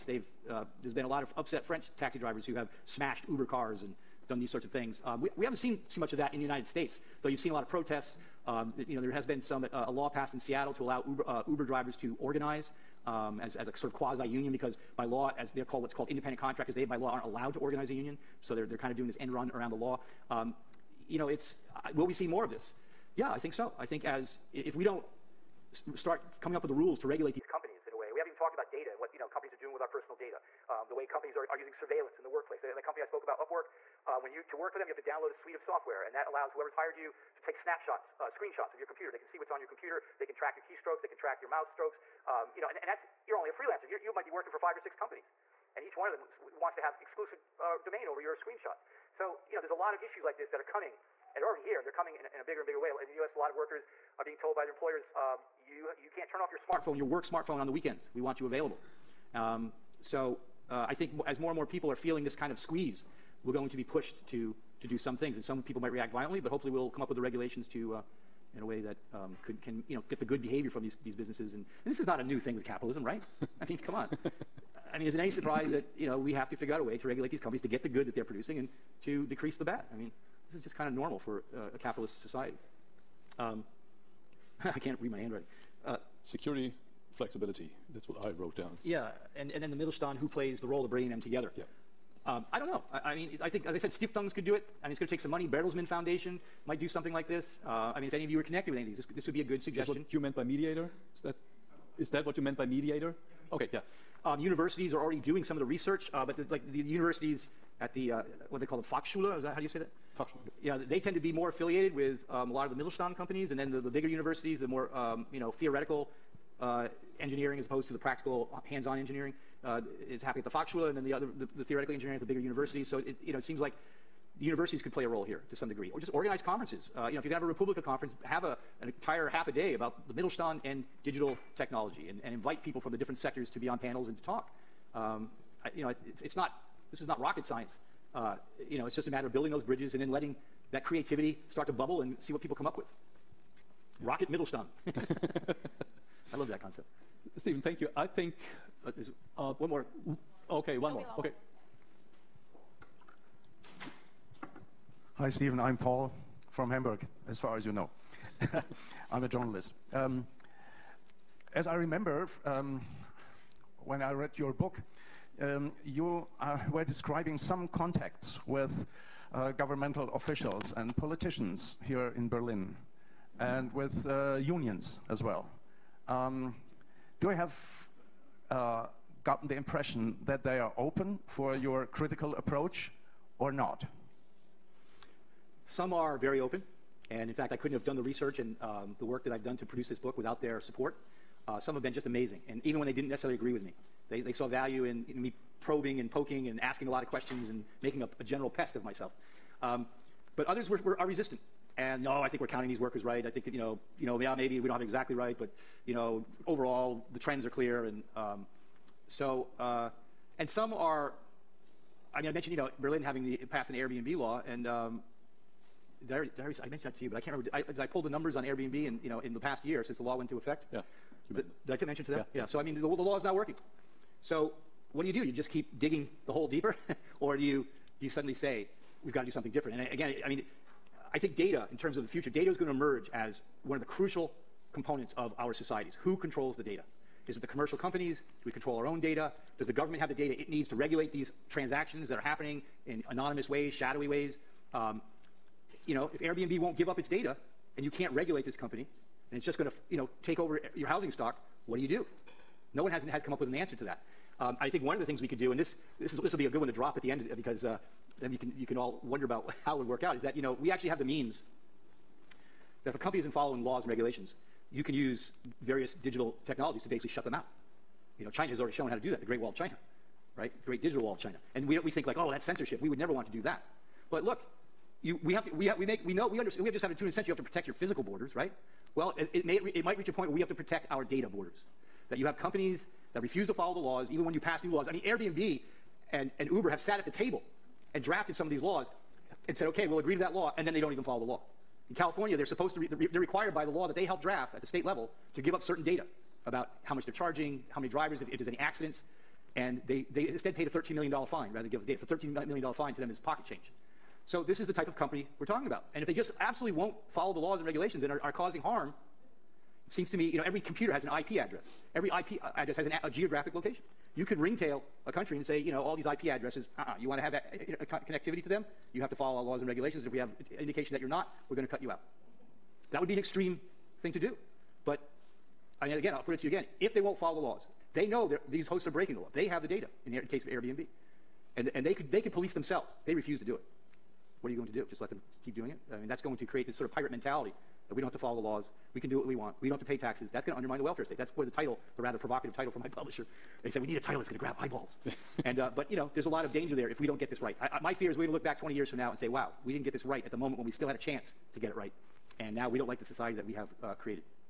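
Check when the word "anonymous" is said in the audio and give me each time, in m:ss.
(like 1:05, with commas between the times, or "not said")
4:03.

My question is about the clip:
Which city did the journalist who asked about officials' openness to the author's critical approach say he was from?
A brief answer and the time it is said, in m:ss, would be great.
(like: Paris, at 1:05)
Hamburg, at 2:36.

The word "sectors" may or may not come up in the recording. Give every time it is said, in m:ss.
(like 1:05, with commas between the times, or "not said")
2:13.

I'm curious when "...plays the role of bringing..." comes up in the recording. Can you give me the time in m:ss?
1:30.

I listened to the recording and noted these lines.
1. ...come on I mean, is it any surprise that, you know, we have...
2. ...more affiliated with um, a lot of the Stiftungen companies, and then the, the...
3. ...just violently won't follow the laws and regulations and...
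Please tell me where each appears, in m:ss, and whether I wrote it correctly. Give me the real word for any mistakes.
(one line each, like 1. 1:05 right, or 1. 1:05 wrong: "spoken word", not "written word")
1. 1:13 right
2. 1:51 wrong: "Mittelstand", not "Stiftungen"
3. 5:06 wrong: "absolutely", not "violently".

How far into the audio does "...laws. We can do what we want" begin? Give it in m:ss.
5:38.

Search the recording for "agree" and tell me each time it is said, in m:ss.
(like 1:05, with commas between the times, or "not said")
3:13, 4:49.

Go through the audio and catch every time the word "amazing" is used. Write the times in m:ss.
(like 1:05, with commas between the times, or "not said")
3:12.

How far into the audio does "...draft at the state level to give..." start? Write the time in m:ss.
4:54.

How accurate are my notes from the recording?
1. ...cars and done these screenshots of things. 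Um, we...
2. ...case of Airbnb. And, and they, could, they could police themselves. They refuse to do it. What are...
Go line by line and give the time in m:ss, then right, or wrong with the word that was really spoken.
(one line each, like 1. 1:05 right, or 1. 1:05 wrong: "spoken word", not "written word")
1. 0:03 wrong: "sorts", not "screenshots"
2. 5:30 right.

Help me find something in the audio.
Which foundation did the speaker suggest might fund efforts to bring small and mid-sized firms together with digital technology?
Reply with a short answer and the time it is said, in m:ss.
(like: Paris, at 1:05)
Bertelsmann Foundation, at 1:35.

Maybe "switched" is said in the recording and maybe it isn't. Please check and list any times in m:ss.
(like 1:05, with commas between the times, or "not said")
not said.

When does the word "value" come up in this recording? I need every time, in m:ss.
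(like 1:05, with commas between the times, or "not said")
3:14.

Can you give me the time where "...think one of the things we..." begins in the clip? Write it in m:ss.
4:14.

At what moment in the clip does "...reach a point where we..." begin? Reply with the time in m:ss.
4:39.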